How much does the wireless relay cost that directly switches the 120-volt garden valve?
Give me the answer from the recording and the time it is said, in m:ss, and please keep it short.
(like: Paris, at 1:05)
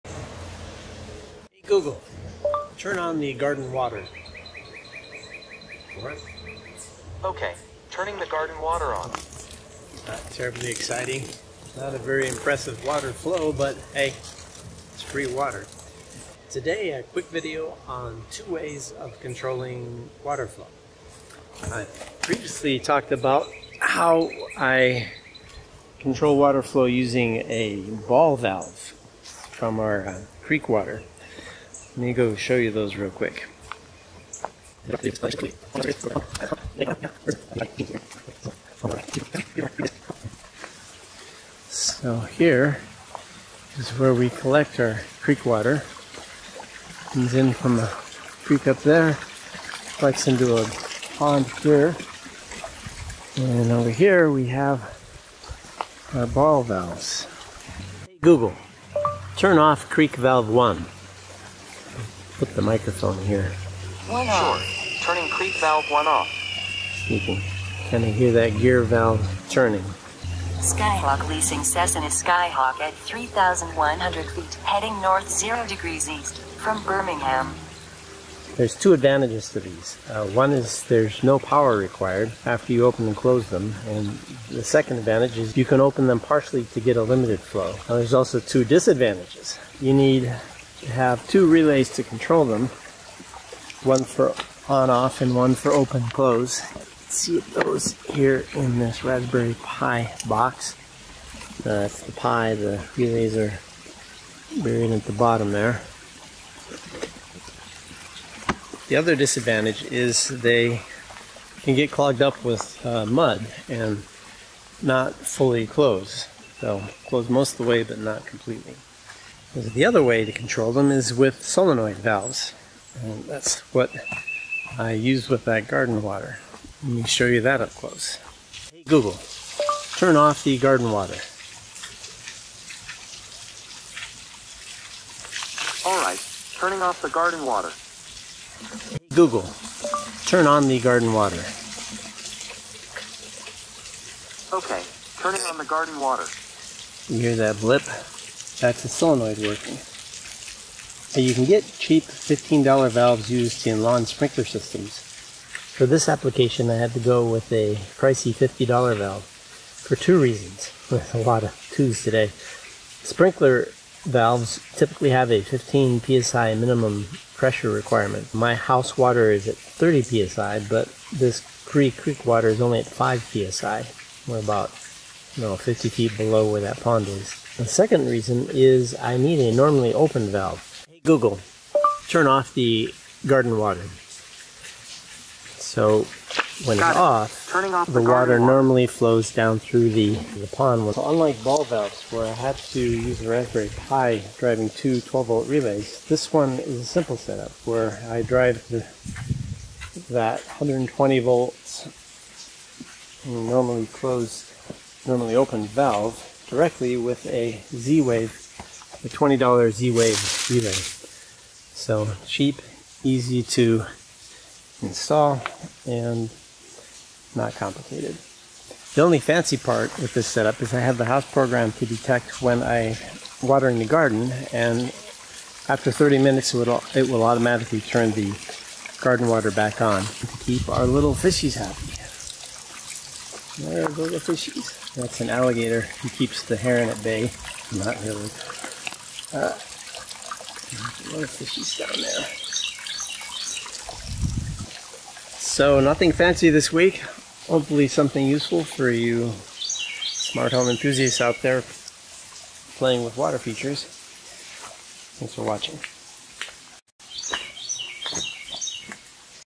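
$20, at 3:29.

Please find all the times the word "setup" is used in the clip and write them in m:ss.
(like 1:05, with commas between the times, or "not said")
3:17, 3:40.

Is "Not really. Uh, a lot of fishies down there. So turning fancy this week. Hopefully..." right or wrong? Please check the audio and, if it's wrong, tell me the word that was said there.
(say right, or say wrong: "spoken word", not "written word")
wrong: "nothing", not "turning".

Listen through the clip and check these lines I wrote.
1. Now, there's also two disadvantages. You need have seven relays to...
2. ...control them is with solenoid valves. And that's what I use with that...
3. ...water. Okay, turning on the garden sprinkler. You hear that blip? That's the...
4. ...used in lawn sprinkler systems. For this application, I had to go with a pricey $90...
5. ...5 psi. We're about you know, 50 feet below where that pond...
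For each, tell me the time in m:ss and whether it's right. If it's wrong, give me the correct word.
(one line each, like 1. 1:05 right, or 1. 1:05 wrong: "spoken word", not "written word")
1. 1:27 wrong: "two", not "seven"
2. 2:00 right
3. 2:21 wrong: "water", not "sprinkler"
4. 2:33 wrong: "50", not "90"
5. 2:52 right.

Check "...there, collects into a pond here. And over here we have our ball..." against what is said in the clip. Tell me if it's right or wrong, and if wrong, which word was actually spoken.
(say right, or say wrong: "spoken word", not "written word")
right.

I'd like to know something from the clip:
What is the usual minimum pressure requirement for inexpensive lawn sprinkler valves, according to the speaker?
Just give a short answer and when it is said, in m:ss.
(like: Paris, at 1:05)
15 psi, at 2:45.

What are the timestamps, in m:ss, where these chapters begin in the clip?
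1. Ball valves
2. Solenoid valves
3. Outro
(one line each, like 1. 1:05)
1. 0:57
2. 2:00
3. 4:05.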